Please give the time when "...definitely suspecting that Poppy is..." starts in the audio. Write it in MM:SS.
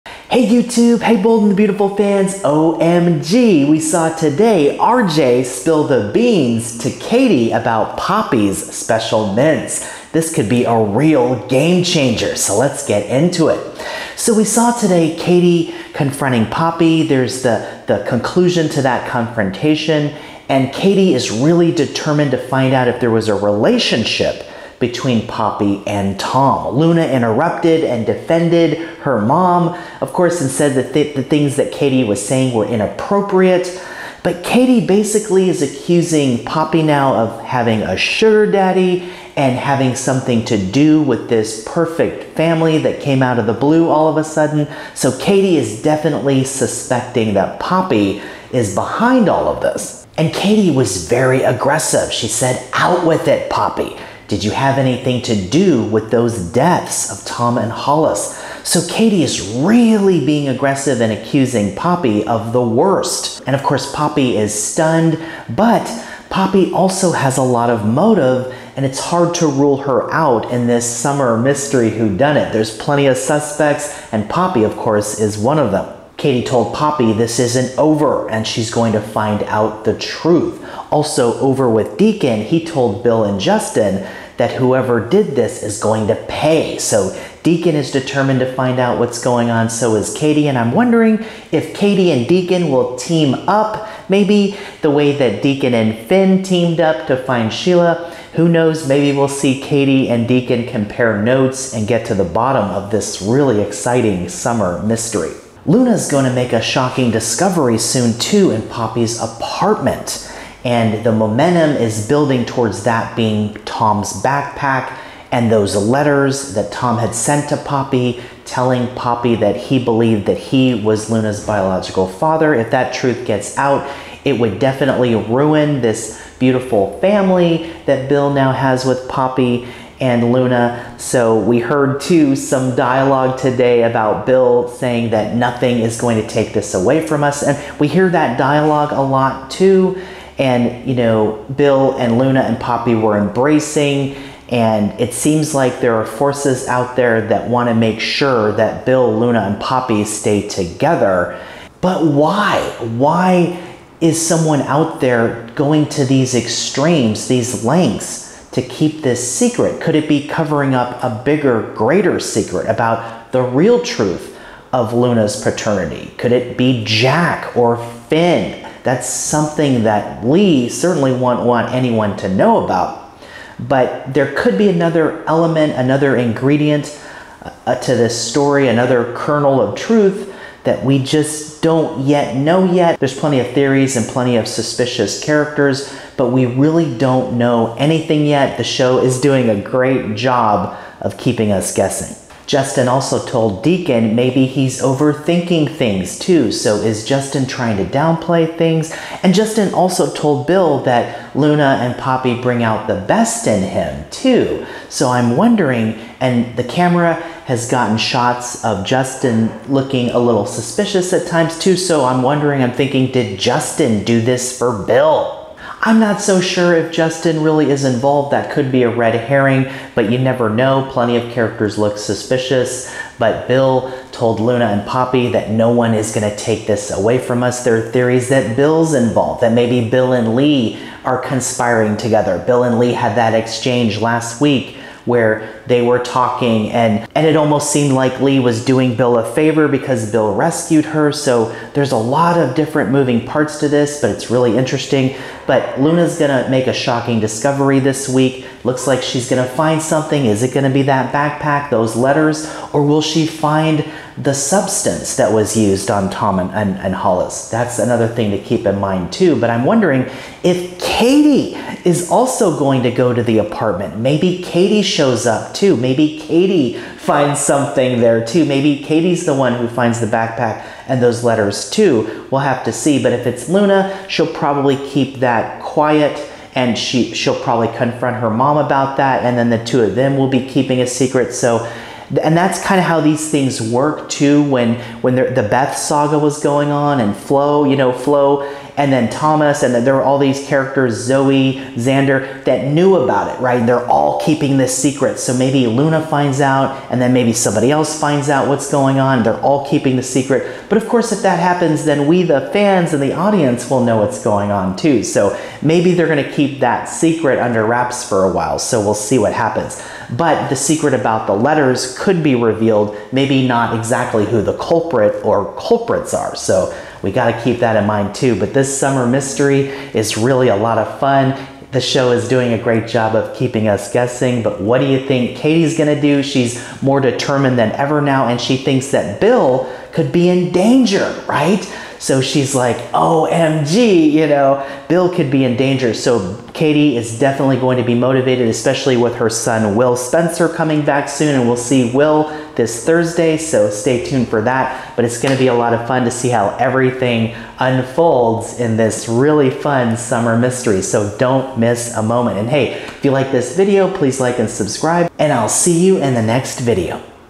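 00:45.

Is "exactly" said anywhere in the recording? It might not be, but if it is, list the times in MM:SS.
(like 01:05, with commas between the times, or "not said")
05:13.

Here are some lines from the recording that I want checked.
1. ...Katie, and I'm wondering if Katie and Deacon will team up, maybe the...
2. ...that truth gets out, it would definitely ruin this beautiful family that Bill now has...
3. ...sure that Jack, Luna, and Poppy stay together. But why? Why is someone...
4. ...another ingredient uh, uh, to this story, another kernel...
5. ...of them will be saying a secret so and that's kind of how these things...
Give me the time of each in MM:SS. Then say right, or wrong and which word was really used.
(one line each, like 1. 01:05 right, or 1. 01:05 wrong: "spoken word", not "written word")
1. 01:30 right
2. 02:02 right
3. 02:28 wrong: "Bill", not "Jack"
4. 02:55 right
5. 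04:39 wrong: "keeping", not "saying".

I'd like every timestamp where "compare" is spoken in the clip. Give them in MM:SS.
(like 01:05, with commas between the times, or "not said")
01:40.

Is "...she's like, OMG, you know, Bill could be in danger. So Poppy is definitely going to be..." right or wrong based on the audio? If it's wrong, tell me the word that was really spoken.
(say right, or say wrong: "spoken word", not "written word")
wrong: "Katie", not "Poppy".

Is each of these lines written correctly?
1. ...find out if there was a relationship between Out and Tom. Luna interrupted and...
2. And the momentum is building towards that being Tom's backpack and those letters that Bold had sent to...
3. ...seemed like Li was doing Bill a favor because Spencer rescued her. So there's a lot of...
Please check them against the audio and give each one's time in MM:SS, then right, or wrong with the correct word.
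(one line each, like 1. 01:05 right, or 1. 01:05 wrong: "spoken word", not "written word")
1. 00:22 wrong: "Poppy", not "Out"
2. 01:50 wrong: "Tom", not "Bold"
3. 03:57 wrong: "Bill", not "Spencer".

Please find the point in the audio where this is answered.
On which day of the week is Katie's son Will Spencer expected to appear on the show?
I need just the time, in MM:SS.
05:42.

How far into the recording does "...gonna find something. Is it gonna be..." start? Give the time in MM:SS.
04:09.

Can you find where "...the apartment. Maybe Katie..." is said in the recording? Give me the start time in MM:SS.
04:23.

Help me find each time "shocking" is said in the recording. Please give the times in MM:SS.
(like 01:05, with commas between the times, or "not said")
01:46, 04:06.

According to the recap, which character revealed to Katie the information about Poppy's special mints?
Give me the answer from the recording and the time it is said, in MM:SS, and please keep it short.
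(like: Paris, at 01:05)
RJ, at 00:04.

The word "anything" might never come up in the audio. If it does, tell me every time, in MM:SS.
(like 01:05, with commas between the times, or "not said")
00:54, 03:07.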